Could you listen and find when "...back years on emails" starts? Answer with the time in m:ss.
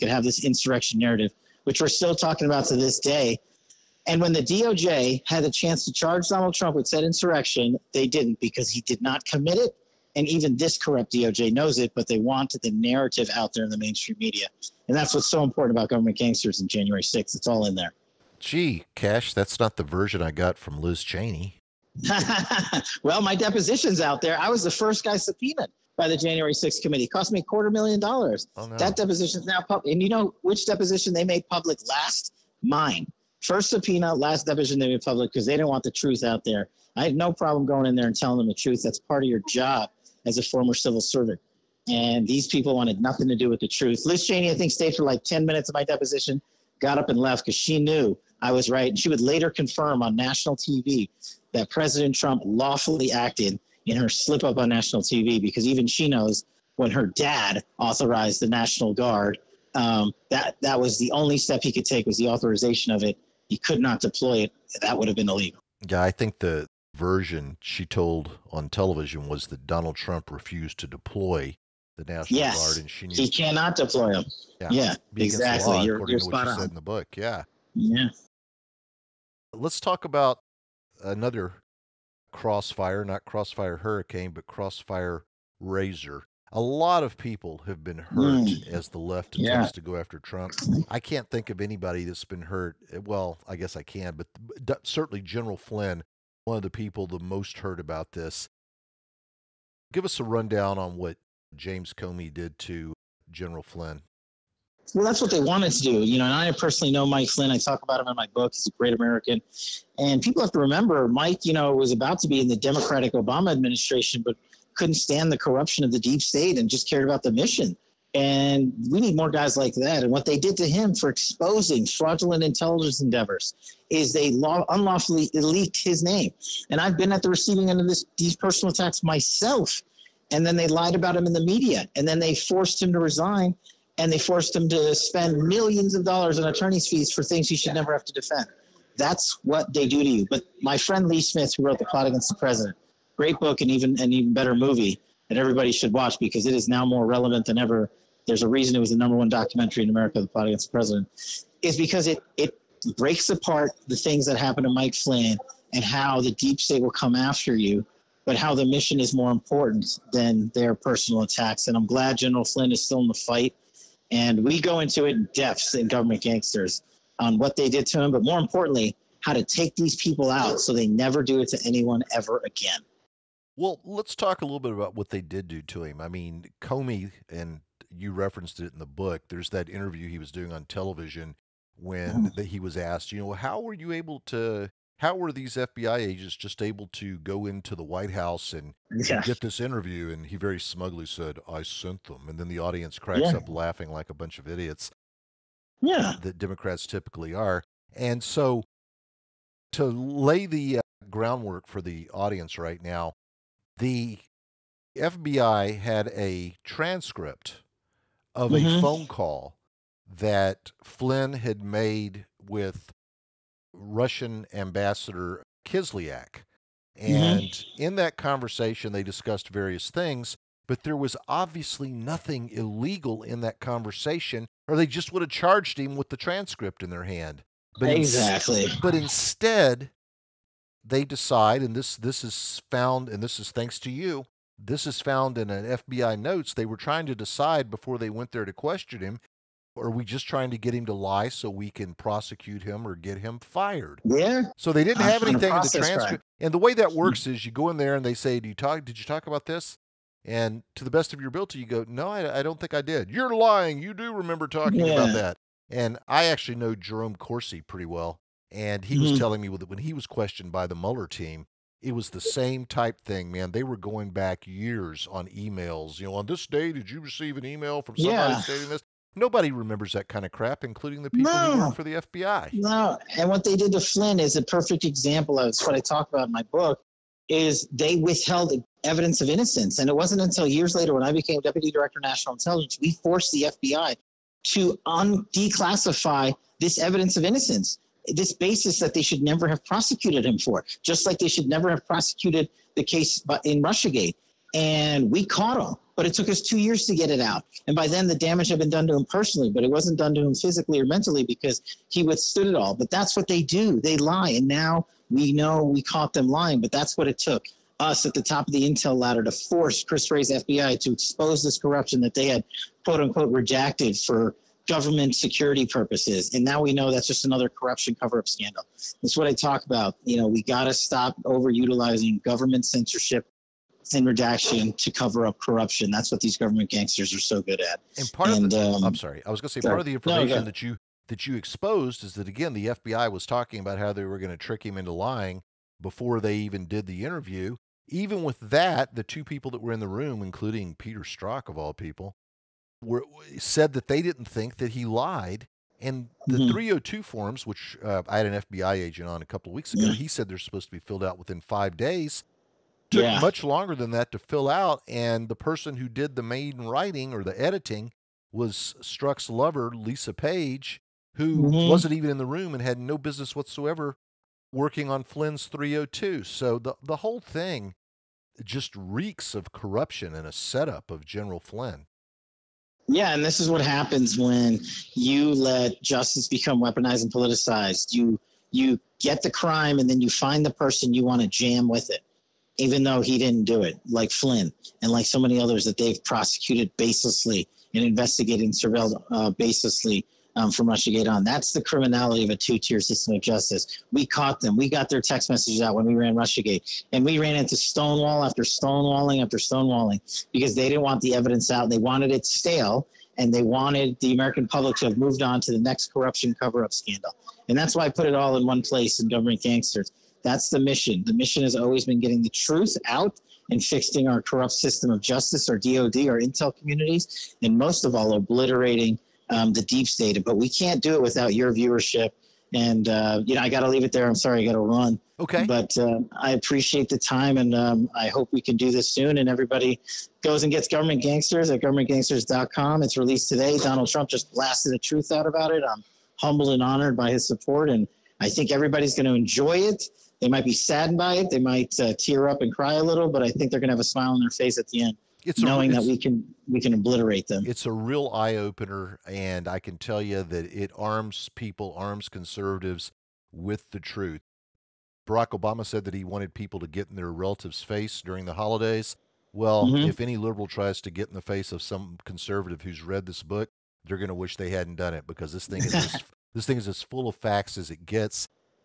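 4:24.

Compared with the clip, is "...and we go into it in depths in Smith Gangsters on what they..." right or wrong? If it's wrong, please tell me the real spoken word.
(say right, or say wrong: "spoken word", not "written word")
wrong: "Government", not "Smith".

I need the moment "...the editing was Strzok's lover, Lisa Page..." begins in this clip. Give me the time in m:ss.
5:57.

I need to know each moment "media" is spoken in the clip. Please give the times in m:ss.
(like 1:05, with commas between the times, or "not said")
0:14, 2:11.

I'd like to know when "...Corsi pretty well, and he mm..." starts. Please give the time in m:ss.
4:17.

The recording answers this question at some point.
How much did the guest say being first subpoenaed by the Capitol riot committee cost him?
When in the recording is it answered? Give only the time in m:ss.
0:27.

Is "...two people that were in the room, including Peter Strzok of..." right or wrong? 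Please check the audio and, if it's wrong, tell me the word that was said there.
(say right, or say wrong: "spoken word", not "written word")
right.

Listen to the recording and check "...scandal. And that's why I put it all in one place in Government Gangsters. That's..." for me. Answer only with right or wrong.
right.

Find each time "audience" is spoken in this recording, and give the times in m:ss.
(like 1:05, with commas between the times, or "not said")
3:12, 3:22.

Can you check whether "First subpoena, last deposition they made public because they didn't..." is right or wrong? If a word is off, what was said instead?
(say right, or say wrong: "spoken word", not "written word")
right.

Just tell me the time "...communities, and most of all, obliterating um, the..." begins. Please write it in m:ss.
6:56.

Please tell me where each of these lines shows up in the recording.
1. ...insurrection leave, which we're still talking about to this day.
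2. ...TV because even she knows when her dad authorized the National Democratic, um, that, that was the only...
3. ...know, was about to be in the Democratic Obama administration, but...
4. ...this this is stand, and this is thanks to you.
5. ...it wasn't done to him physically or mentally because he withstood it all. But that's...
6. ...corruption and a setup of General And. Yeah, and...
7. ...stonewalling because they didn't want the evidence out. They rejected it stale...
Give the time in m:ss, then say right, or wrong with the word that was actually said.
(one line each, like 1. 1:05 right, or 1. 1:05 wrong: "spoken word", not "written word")
1. 0:00 wrong: "narrative", not "leave"
2. 0:55 wrong: "Guard", not "Democratic"
3. 1:51 right
4. 3:51 wrong: "found", not "stand"
5. 4:59 right
6. 6:09 wrong: "Flynn", not "And"
7. 6:39 wrong: "wanted", not "rejected".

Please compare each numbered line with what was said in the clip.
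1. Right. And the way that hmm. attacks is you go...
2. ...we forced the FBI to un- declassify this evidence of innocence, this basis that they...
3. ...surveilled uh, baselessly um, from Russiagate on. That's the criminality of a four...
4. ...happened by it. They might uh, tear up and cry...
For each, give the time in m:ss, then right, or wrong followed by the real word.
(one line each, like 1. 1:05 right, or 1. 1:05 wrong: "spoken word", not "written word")
1. 4:06 wrong: "works", not "attacks"
2. 4:42 right
3. 6:28 wrong: "two", not "four"
4. 7:20 wrong: "saddened", not "happened".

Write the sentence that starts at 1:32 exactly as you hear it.
Eh, well, I guess I can, but certainly General Flynn, one of the people the most hurt about this.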